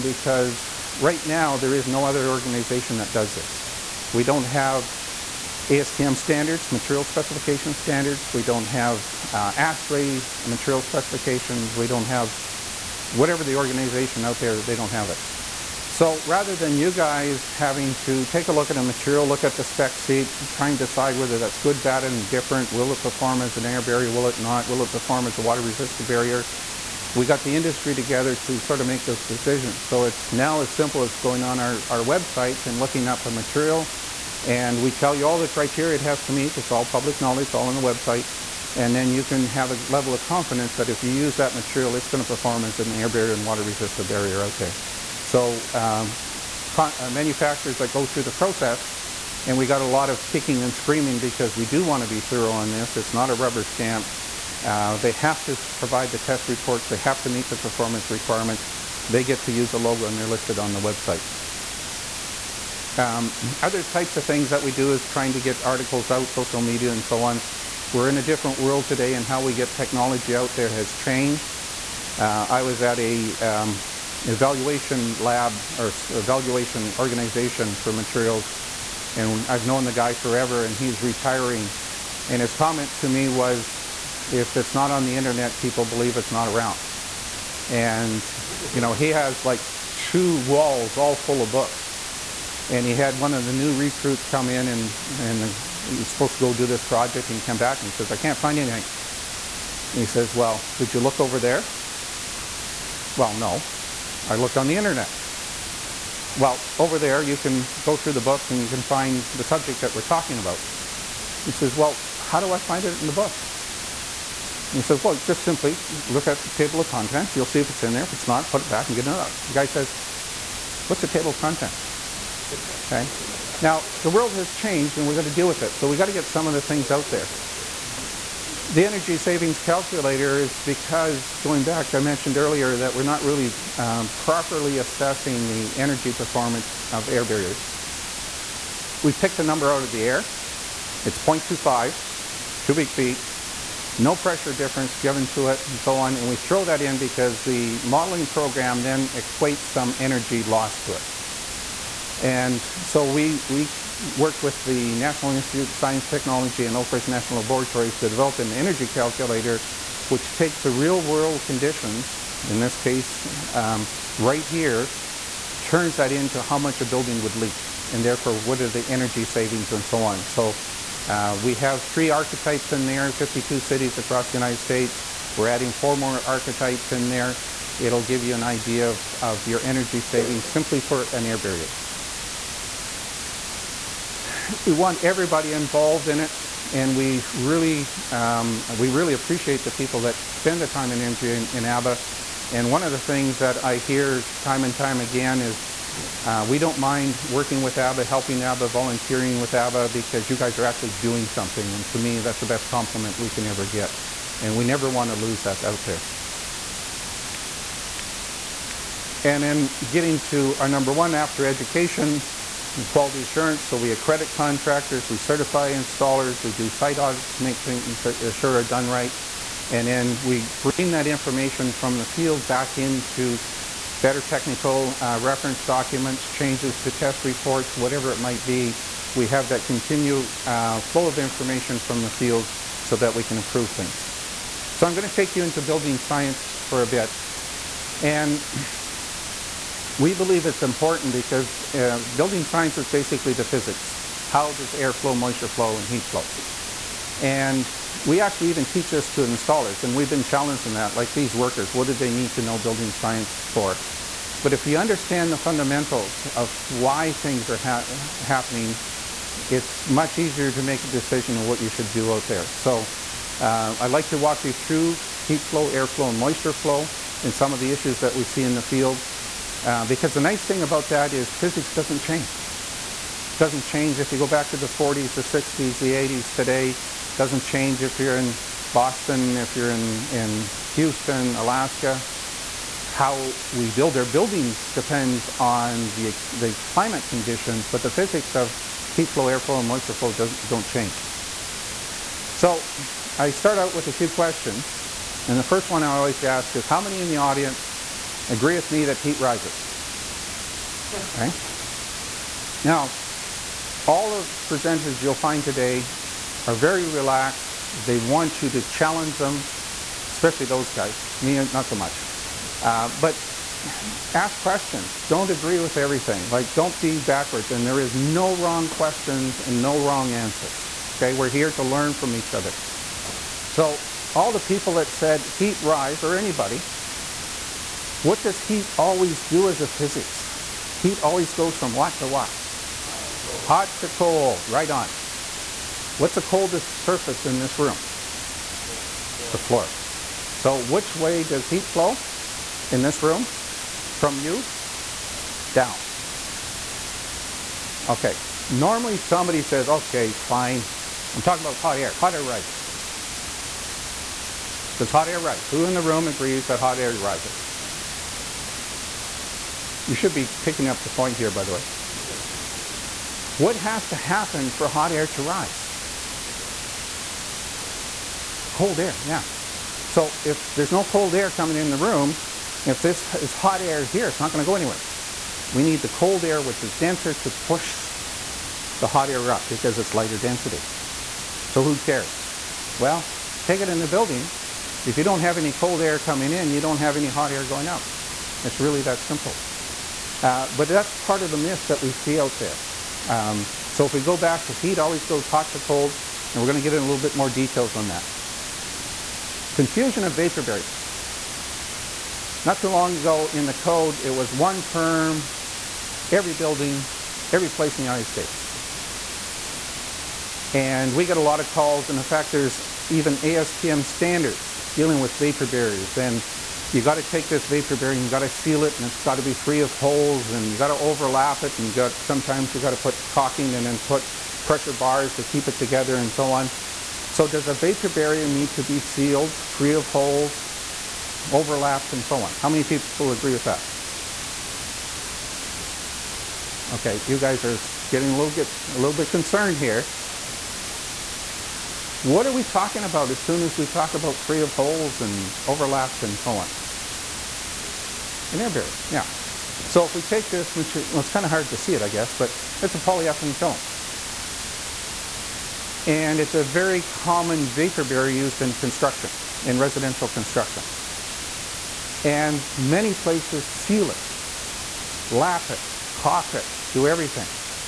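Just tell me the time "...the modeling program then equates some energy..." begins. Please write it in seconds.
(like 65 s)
147 s.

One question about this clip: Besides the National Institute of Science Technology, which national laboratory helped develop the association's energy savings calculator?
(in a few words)
Oak Ridge National Laboratories.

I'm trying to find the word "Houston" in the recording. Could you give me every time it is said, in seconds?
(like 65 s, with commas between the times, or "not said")
280 s.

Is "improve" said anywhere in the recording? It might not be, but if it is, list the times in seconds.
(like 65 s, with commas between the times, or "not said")
233 s.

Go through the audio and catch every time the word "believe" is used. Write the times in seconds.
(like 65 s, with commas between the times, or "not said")
85 s, 240 s.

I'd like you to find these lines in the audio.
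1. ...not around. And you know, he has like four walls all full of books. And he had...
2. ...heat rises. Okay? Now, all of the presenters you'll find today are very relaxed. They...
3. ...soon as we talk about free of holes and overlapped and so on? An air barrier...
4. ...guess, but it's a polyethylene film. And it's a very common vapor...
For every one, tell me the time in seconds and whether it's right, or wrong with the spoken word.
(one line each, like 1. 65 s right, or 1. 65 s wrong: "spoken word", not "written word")
1. 86 s wrong: "two", not "four"
2. 298 s right
3. 443 s right
4. 451 s right.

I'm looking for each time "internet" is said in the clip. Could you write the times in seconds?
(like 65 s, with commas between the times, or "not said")
85 s, 104 s.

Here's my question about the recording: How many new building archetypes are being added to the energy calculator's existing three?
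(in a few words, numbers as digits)
4.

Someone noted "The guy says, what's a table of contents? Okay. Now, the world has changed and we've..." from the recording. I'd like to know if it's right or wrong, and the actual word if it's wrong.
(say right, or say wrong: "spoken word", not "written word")
right.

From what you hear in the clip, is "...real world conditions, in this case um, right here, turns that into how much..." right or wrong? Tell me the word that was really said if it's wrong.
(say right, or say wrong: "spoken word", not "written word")
right.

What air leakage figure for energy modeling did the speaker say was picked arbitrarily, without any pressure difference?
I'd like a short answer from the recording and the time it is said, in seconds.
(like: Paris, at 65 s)
0.25 cubic feet, at 141 s.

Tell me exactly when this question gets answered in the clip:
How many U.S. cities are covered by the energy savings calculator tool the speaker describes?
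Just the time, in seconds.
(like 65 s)
173 s.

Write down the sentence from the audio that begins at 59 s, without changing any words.
They get to use the logo and they're listed on the website.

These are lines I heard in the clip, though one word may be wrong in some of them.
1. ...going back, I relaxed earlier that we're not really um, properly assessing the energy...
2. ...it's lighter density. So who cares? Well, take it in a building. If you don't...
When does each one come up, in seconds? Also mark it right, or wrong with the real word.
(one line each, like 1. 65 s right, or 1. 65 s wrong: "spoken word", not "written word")
1. 131 s wrong: "mentioned", not "relaxed"
2. 379 s right.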